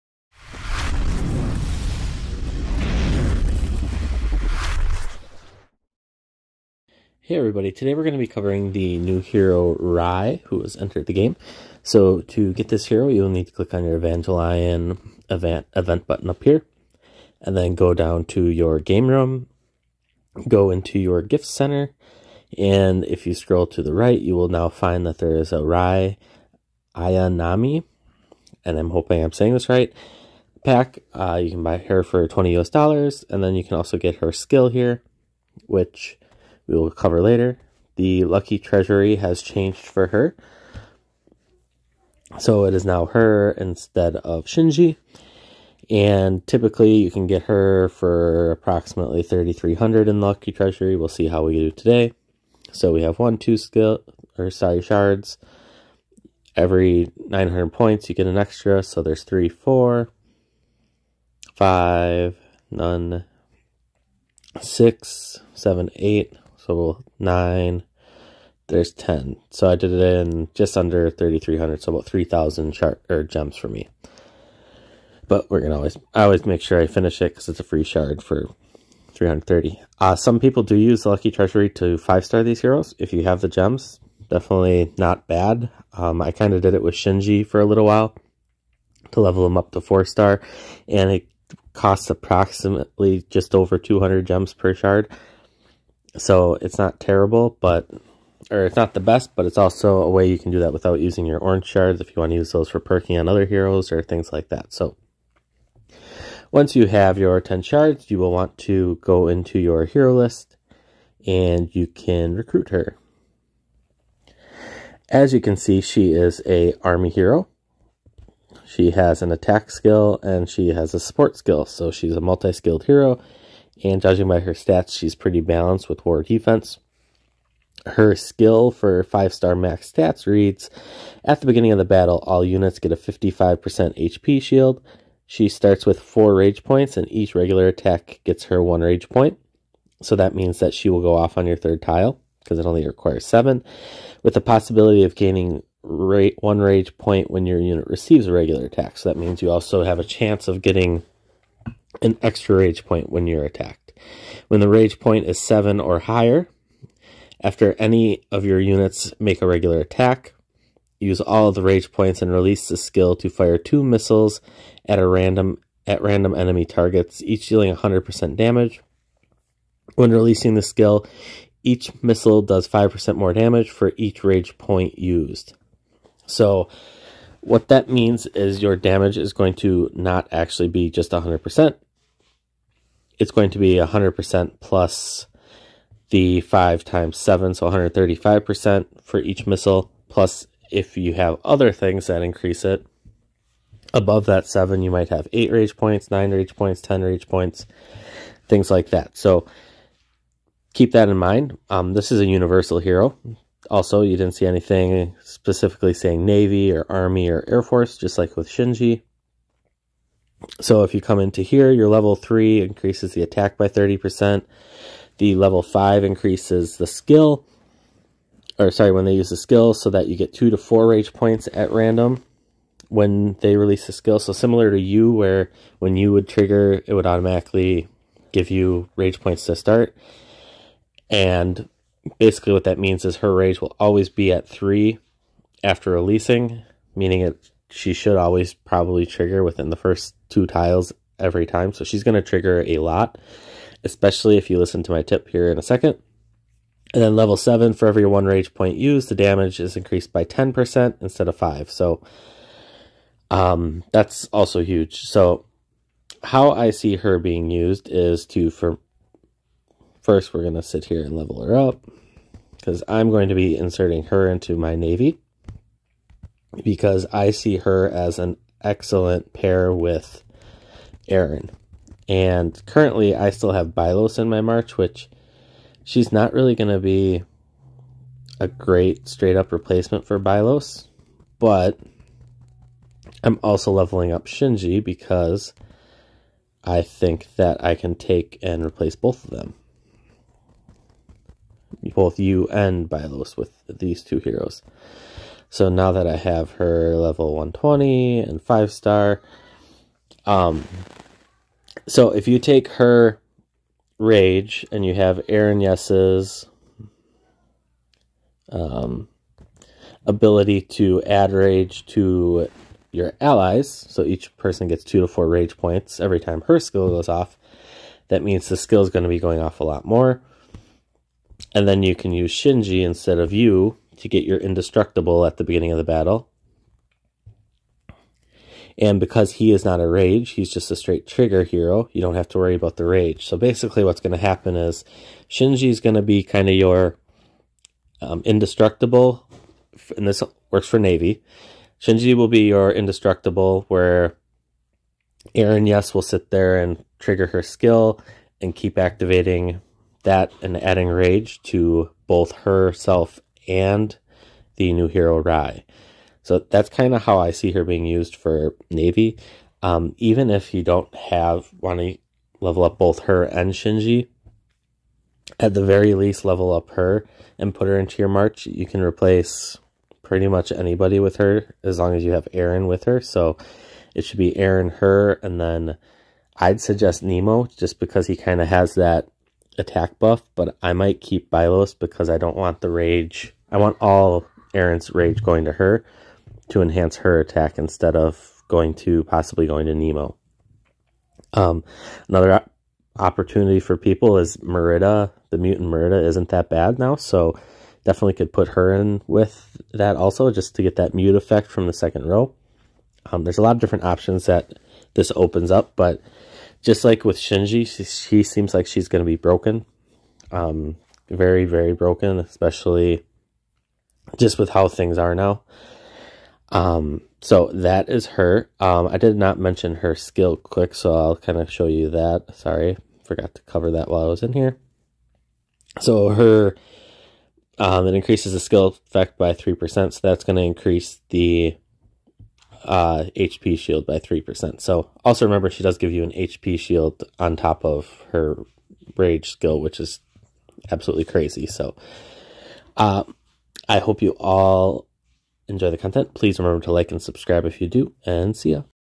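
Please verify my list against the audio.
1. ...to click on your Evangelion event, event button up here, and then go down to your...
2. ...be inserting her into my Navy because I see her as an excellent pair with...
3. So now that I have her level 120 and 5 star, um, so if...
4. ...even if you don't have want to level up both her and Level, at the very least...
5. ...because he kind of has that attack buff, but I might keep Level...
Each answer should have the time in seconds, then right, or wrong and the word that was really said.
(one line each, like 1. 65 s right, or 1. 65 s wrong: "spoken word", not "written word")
1. 13 s right
2. 263 s right
3. 295 s right
4. 359 s wrong: "Shinji", not "Level"
5. 377 s wrong: "Bylos", not "Level".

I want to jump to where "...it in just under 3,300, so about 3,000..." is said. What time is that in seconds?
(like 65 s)
69 s.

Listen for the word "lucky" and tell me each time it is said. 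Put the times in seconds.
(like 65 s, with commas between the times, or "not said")
38 s, 50 s, 81 s.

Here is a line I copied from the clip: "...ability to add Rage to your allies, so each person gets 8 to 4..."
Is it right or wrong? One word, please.
wrong.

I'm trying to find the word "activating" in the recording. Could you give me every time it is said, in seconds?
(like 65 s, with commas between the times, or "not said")
348 s.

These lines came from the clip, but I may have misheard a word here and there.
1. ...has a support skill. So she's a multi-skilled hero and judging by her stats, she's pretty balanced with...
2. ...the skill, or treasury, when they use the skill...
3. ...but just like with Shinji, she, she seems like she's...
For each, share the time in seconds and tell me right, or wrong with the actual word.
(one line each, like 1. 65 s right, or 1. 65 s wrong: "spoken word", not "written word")
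1. 120 s right
2. 216 s wrong: "sorry", not "treasury"
3. 405 s right.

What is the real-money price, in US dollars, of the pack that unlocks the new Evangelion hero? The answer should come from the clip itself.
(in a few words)
$20.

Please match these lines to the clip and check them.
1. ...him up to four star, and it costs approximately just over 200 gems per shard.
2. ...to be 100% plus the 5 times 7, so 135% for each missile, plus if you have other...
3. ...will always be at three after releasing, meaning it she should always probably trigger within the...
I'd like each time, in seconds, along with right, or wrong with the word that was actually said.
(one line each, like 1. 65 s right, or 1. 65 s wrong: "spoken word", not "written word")
1. 89 s right
2. 183 s right
3. 233 s right.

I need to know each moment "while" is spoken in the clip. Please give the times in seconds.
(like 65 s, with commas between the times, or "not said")
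87 s, 423 s.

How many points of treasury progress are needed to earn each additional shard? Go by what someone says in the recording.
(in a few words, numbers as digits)
900.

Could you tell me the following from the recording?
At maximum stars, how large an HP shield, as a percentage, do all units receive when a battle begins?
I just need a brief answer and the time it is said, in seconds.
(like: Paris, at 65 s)
55%, at 132 s.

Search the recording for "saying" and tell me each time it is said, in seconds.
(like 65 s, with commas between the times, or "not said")
29 s, 205 s.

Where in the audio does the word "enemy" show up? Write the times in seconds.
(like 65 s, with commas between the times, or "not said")
166 s.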